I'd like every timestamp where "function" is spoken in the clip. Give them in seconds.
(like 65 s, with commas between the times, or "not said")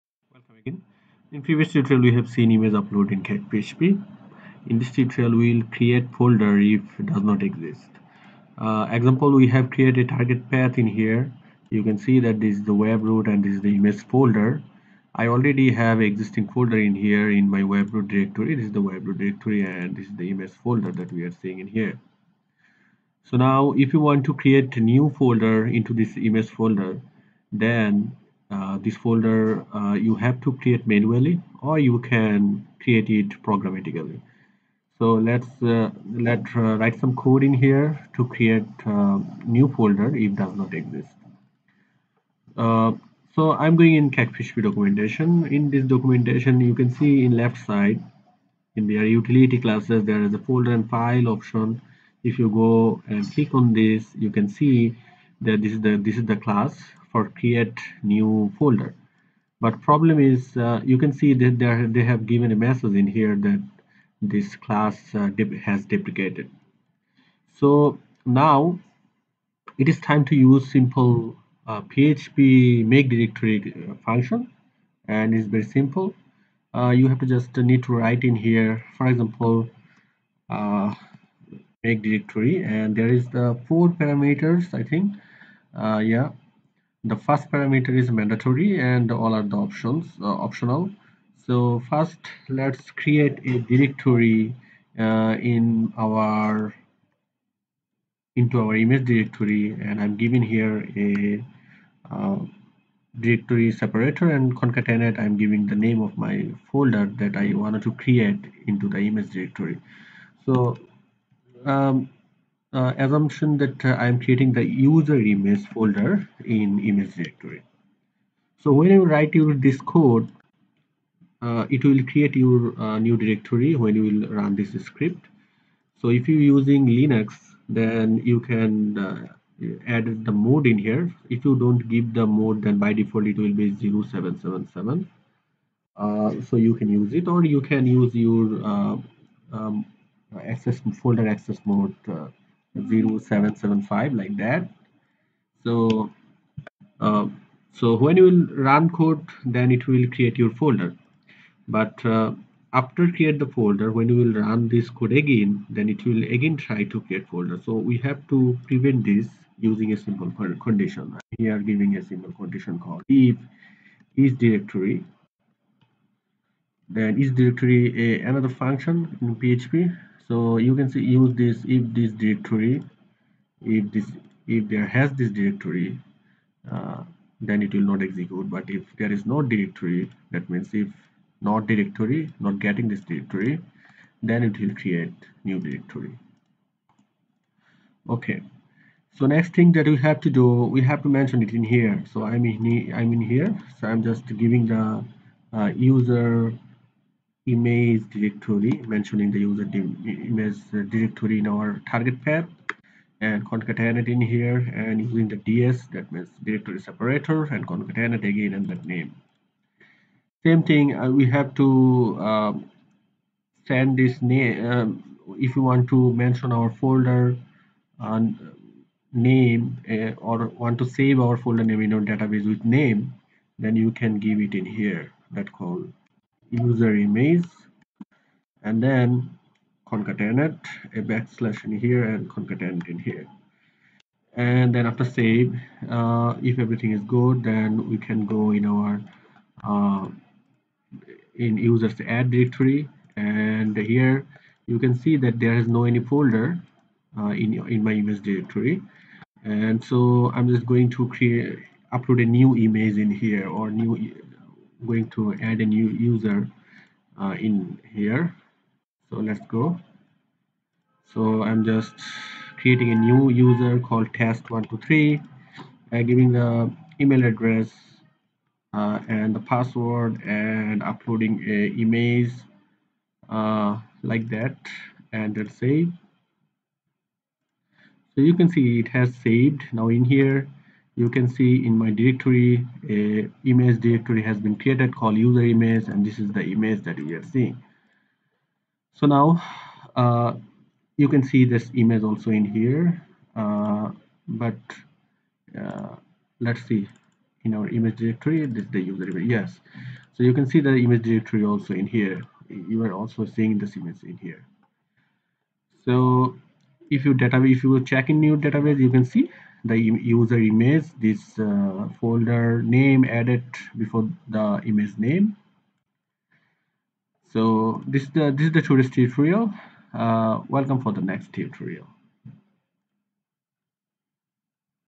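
74 s, 168 s.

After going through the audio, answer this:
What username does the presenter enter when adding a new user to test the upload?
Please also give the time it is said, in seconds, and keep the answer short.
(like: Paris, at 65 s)
test123, at 264 s.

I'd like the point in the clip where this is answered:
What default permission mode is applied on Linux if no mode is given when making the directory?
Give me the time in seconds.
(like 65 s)
133 s.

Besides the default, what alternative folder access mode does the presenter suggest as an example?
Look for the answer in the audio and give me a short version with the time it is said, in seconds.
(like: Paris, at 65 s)
0775, at 142 s.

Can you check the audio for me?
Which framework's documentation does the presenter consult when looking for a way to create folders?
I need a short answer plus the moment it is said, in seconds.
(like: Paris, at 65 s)
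CakePHP, at 44 s.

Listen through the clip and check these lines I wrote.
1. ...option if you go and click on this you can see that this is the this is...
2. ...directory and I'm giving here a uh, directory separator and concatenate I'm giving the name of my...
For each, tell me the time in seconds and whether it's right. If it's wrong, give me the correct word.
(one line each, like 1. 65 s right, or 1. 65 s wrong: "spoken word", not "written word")
1. 51 s right
2. 99 s right.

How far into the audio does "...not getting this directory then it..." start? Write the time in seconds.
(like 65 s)
182 s.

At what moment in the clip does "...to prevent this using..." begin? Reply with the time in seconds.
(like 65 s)
158 s.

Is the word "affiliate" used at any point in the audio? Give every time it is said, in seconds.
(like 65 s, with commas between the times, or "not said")
not said.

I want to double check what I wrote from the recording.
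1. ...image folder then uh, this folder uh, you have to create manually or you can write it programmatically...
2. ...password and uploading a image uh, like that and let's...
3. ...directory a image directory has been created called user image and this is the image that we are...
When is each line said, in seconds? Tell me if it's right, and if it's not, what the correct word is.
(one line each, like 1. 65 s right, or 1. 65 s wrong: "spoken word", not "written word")
1. 26 s wrong: "create", not "write"
2. 269 s right
3. 281 s right.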